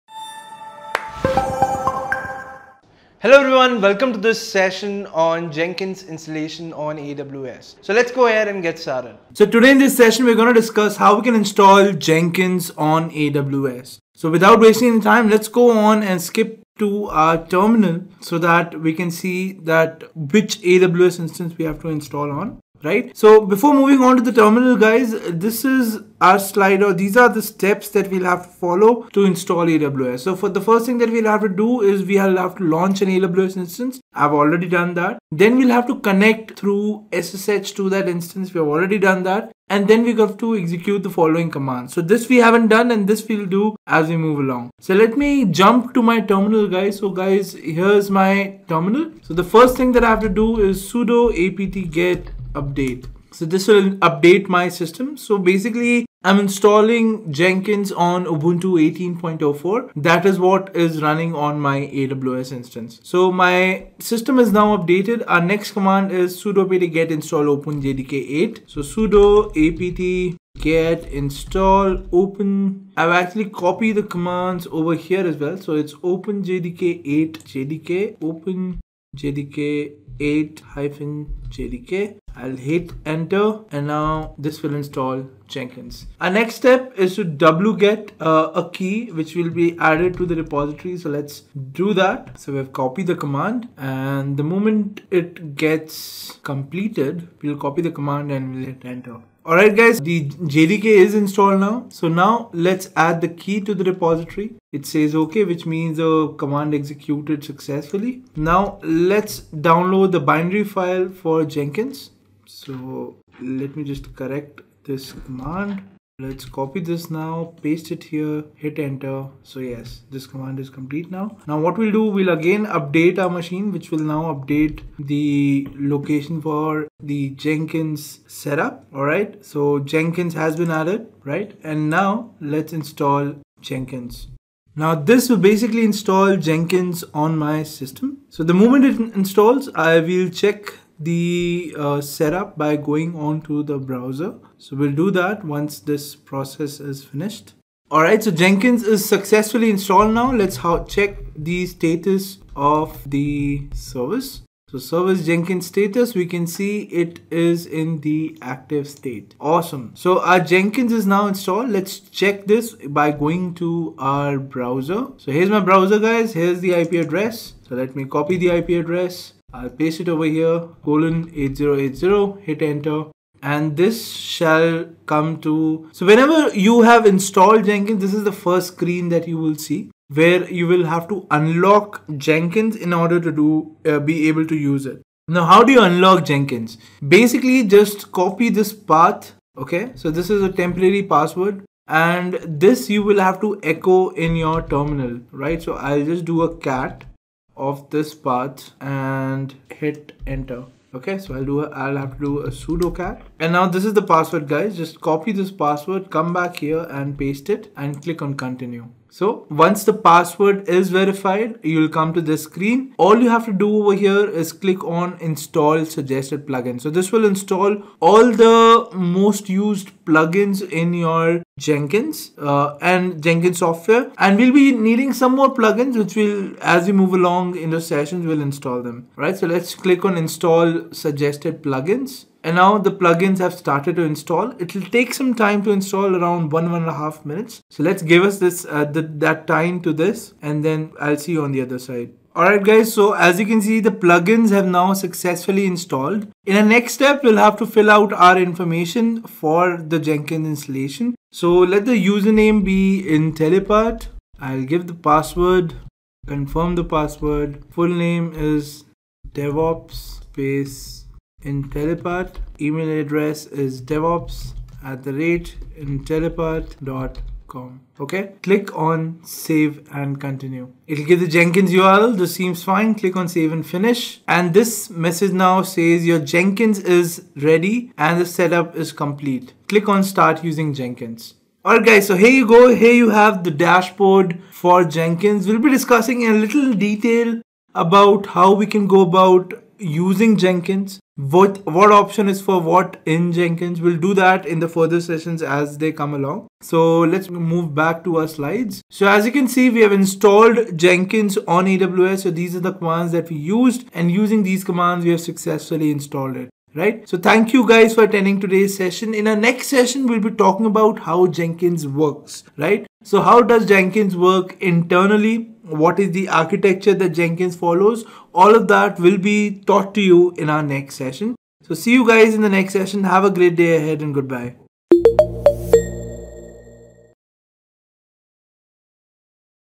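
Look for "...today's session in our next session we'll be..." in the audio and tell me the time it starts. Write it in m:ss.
5:08.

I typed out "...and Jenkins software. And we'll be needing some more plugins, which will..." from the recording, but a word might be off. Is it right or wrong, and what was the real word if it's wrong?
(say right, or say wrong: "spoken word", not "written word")
right.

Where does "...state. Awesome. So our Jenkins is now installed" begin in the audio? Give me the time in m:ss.
2:38.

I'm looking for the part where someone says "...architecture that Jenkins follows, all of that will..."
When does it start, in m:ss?
5:16.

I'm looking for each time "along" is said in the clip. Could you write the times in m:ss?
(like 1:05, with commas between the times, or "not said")
0:44, 3:47, 4:56.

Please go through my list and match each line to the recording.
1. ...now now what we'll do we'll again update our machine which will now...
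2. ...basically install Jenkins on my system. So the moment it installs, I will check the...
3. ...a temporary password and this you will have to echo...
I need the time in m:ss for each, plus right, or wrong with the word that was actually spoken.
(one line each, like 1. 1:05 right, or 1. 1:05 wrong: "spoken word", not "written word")
1. 2:01 right
2. 2:15 right
3. 3:10 right.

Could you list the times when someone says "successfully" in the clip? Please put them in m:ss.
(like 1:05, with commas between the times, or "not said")
1:47, 2:29, 4:04, 5:05.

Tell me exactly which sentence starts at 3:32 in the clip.
All you have to do over here is click on install suggested plugin.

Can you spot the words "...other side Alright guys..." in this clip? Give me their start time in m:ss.
4:01.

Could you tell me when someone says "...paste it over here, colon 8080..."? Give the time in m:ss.
2:49.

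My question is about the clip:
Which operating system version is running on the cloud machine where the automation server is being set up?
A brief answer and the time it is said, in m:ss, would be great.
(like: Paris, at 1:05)
Ubuntu 18.04, at 0:58.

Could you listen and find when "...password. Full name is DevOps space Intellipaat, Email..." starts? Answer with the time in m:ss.
4:16.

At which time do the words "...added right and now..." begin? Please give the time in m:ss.
2:10.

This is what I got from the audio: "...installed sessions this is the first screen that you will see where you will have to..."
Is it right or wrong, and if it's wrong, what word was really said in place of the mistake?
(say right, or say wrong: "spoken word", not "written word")
wrong: "jenkins", not "sessions".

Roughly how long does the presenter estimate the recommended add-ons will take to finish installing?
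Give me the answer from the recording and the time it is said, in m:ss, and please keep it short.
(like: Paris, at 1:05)
one and a half minutes, at 3:56.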